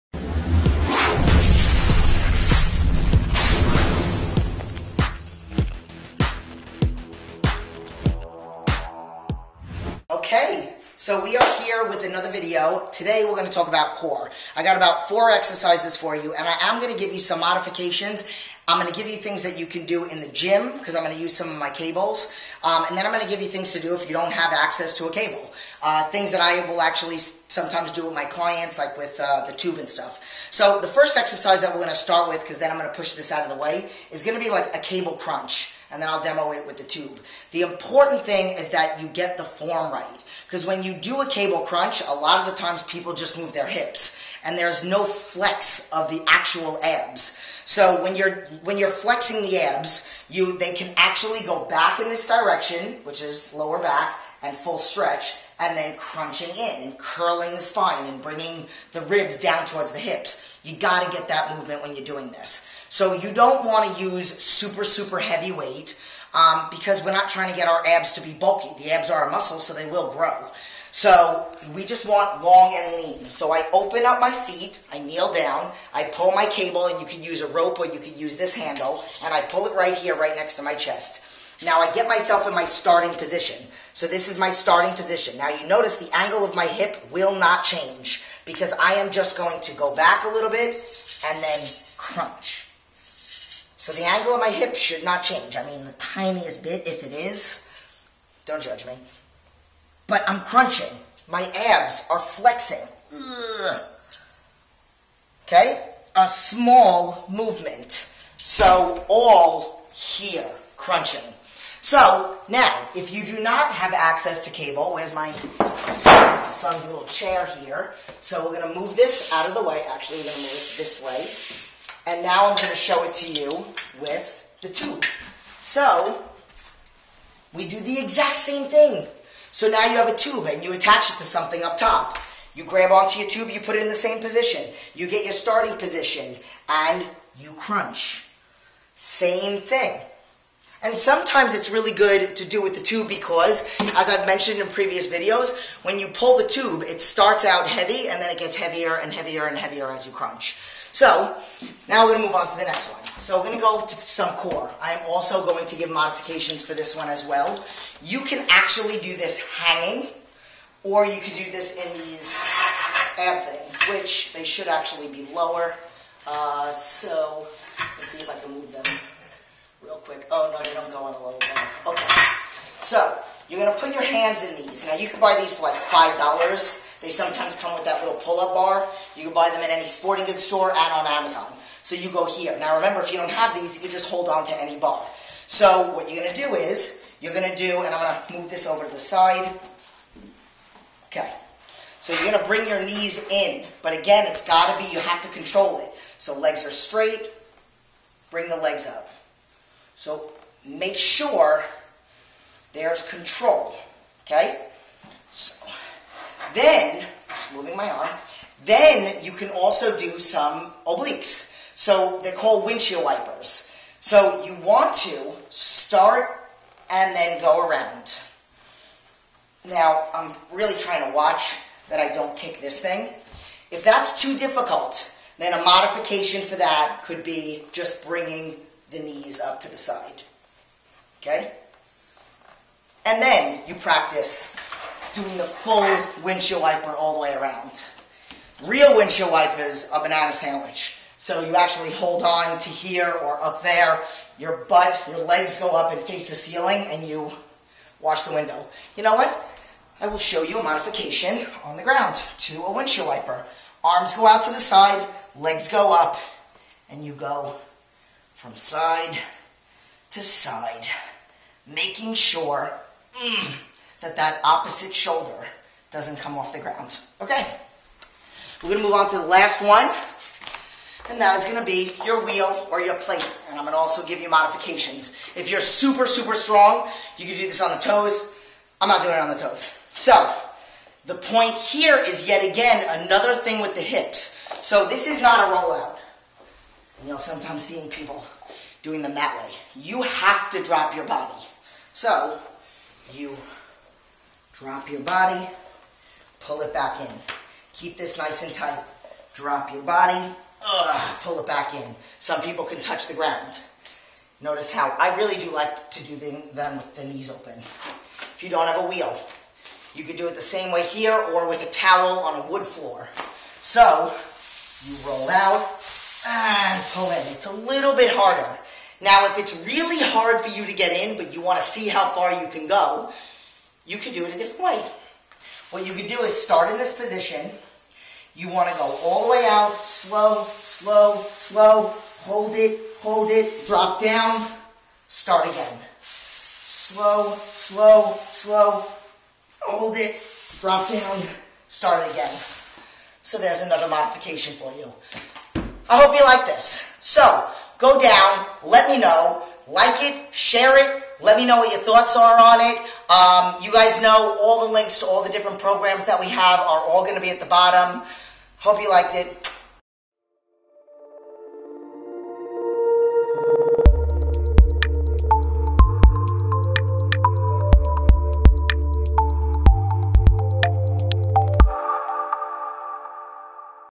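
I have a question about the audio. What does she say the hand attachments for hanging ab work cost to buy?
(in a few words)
$5.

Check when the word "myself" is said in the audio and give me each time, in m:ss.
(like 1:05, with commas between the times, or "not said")
1:22.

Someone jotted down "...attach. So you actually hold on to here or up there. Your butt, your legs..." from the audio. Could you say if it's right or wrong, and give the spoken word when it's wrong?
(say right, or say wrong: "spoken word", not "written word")
wrong: "sandwich", not "attach".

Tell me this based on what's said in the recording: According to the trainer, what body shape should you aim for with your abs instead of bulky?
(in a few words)
long and lean.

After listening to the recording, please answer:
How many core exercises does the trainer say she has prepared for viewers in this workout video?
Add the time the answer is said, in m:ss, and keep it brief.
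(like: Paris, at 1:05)
4, at 0:15.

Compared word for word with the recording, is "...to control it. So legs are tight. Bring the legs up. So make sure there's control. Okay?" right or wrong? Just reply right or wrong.
wrong.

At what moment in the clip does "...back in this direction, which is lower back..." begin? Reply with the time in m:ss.
0:51.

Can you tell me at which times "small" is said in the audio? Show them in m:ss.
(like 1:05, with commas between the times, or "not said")
1:46.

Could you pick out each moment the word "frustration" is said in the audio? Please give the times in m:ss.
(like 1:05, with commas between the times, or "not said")
not said.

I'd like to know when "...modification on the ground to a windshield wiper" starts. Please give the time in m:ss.
4:10.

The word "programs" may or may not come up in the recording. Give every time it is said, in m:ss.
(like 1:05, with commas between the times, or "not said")
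5:55.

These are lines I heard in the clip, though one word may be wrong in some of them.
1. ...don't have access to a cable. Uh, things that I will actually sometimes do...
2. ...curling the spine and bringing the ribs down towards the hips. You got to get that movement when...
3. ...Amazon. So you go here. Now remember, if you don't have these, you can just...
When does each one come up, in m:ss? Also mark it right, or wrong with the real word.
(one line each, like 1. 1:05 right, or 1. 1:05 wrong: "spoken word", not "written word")
1. 0:24 right
2. 0:56 right
3. 3:01 right.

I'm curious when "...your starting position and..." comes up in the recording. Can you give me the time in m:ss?
2:15.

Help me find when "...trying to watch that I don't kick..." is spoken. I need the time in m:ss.
3:40.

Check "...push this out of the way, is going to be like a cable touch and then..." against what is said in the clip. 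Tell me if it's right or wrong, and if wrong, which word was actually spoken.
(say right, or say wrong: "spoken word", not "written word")
wrong: "crunch", not "touch".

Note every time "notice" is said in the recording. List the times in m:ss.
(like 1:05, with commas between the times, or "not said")
1:25, 5:04.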